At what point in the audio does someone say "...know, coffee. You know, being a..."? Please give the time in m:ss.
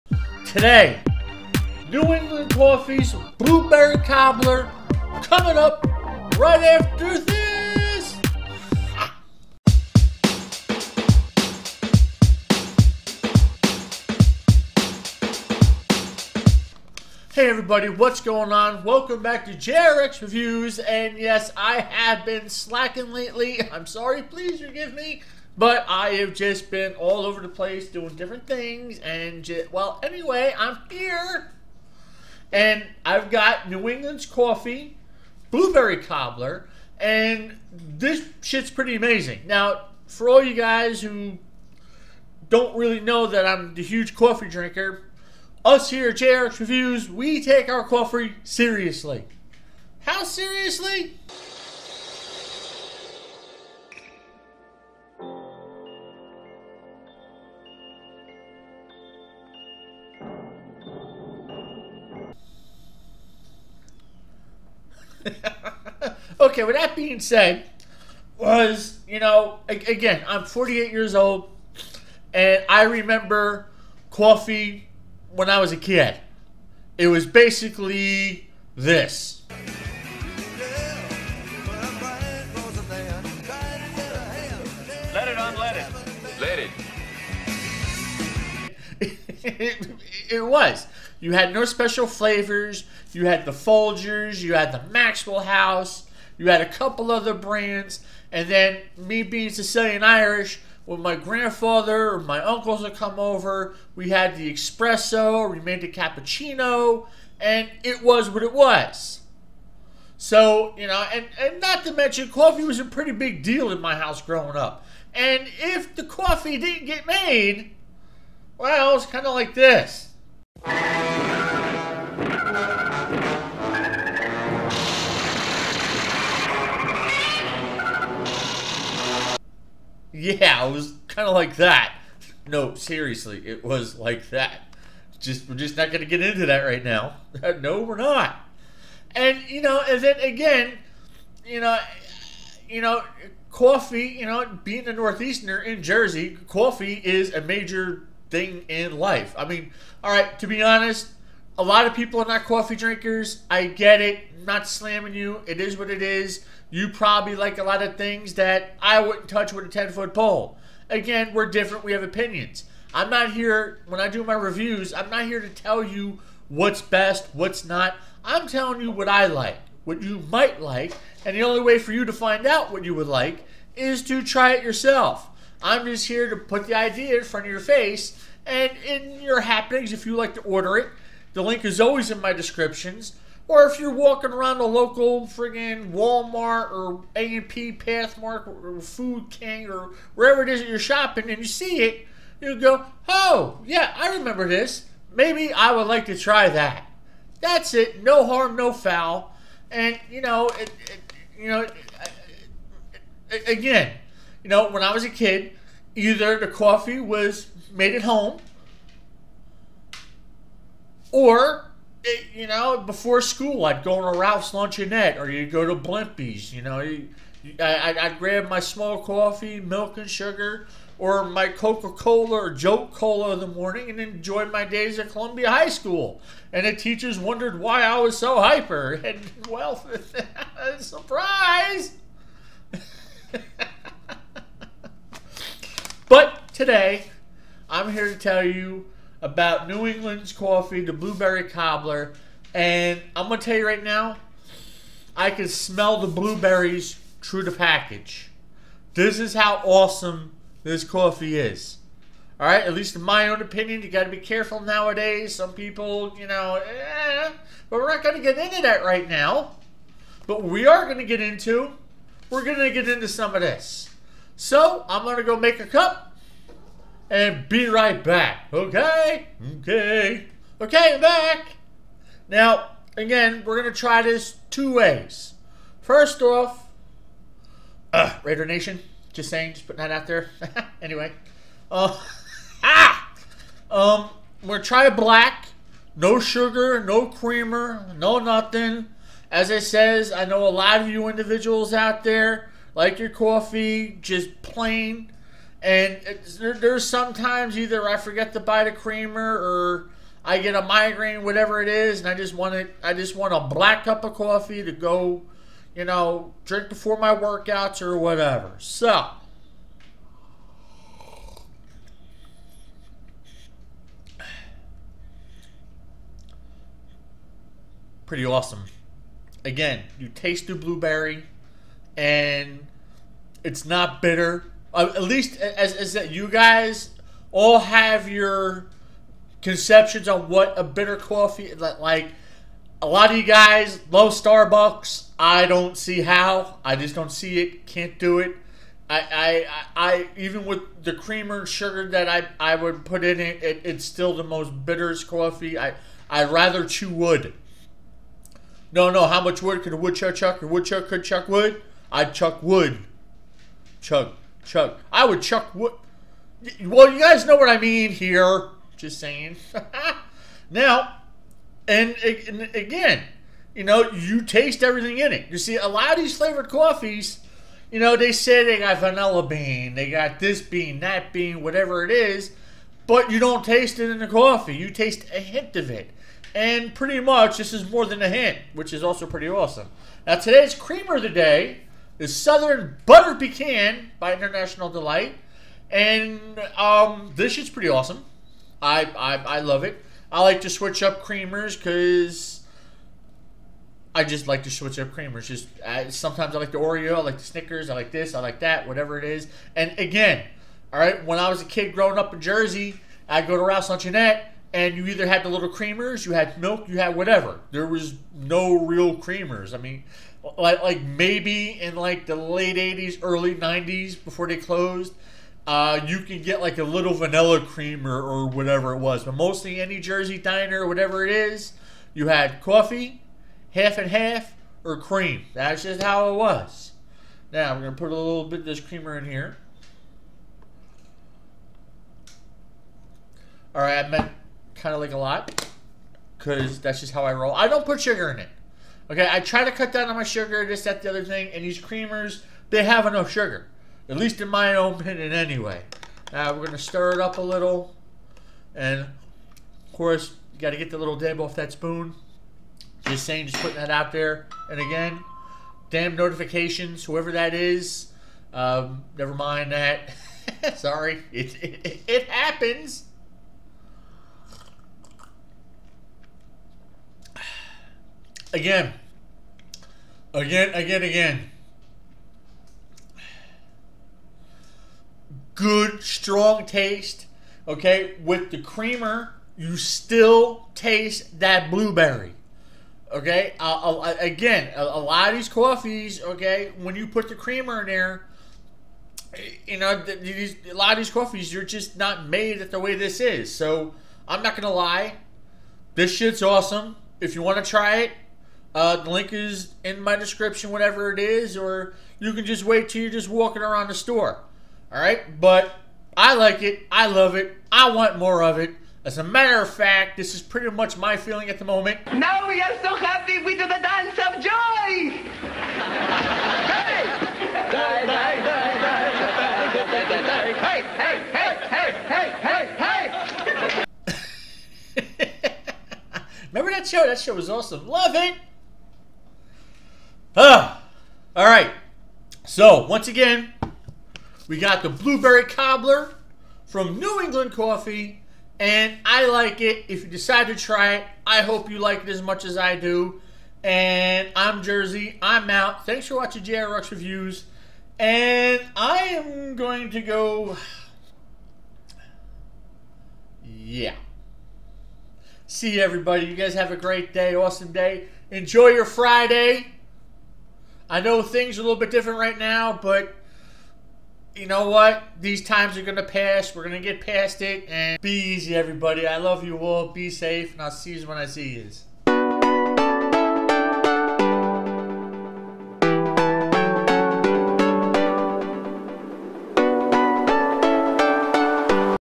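2:22.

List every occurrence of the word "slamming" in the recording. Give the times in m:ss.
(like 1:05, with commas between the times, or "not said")
2:34.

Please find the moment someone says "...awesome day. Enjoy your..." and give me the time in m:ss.
9:17.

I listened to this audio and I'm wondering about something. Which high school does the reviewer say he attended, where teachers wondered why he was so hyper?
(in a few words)
Columbia High School.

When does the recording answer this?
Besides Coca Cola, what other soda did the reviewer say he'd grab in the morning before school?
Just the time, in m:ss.
3:42.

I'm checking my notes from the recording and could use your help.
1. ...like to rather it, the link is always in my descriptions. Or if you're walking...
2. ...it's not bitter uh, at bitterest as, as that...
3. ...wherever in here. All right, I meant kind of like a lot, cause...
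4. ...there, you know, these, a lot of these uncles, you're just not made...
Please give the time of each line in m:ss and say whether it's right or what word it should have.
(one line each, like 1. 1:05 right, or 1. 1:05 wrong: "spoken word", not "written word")
1. 3:00 wrong: "order", not "rather"
2. 5:23 wrong: "least", not "bitterest"
3. 7:08 wrong: "creamer", not "wherever"
4. 8:07 wrong: "coffees", not "uncles".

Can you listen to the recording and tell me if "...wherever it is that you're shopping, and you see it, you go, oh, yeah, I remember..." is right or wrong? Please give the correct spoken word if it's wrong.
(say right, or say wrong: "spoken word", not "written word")
right.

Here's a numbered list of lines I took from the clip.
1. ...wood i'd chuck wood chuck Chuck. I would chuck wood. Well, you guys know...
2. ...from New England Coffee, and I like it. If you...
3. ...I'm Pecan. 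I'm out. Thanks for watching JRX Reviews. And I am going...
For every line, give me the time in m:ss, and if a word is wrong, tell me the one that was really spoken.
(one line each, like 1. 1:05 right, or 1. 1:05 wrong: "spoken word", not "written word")
1. 5:51 right
2. 8:56 right
3. 9:04 wrong: "Jersey", not "Pecan".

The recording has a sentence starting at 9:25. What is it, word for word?
These times are going to pass.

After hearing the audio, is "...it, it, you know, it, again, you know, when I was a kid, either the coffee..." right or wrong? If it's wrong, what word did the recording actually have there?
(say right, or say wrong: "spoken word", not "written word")
right.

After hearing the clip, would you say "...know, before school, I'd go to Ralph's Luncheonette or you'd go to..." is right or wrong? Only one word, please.
right.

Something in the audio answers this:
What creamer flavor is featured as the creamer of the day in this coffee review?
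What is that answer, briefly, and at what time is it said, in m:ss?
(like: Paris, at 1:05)
Southern Butter Pecan, at 6:22.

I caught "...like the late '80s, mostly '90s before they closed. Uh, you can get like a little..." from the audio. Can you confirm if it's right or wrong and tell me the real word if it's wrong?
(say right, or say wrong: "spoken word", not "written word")
wrong: "early", not "mostly".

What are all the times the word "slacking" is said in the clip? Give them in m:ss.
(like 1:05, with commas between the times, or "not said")
0:22.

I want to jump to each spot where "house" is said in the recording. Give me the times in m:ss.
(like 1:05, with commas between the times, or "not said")
1:35, 1:53.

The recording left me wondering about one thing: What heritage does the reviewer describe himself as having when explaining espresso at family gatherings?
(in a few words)
Sicilian Irish.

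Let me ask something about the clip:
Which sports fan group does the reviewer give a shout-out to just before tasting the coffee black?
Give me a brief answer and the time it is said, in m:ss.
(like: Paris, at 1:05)
Raider Nation, at 4:38.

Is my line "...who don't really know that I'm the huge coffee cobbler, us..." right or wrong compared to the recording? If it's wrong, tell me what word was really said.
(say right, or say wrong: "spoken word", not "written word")
wrong: "drinker", not "cobbler".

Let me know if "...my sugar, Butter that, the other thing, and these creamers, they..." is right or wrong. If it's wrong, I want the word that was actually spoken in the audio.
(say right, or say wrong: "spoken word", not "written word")
wrong: "Just", not "Butter".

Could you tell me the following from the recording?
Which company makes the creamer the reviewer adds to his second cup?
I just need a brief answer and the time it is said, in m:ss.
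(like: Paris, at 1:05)
International Delight, at 6:24.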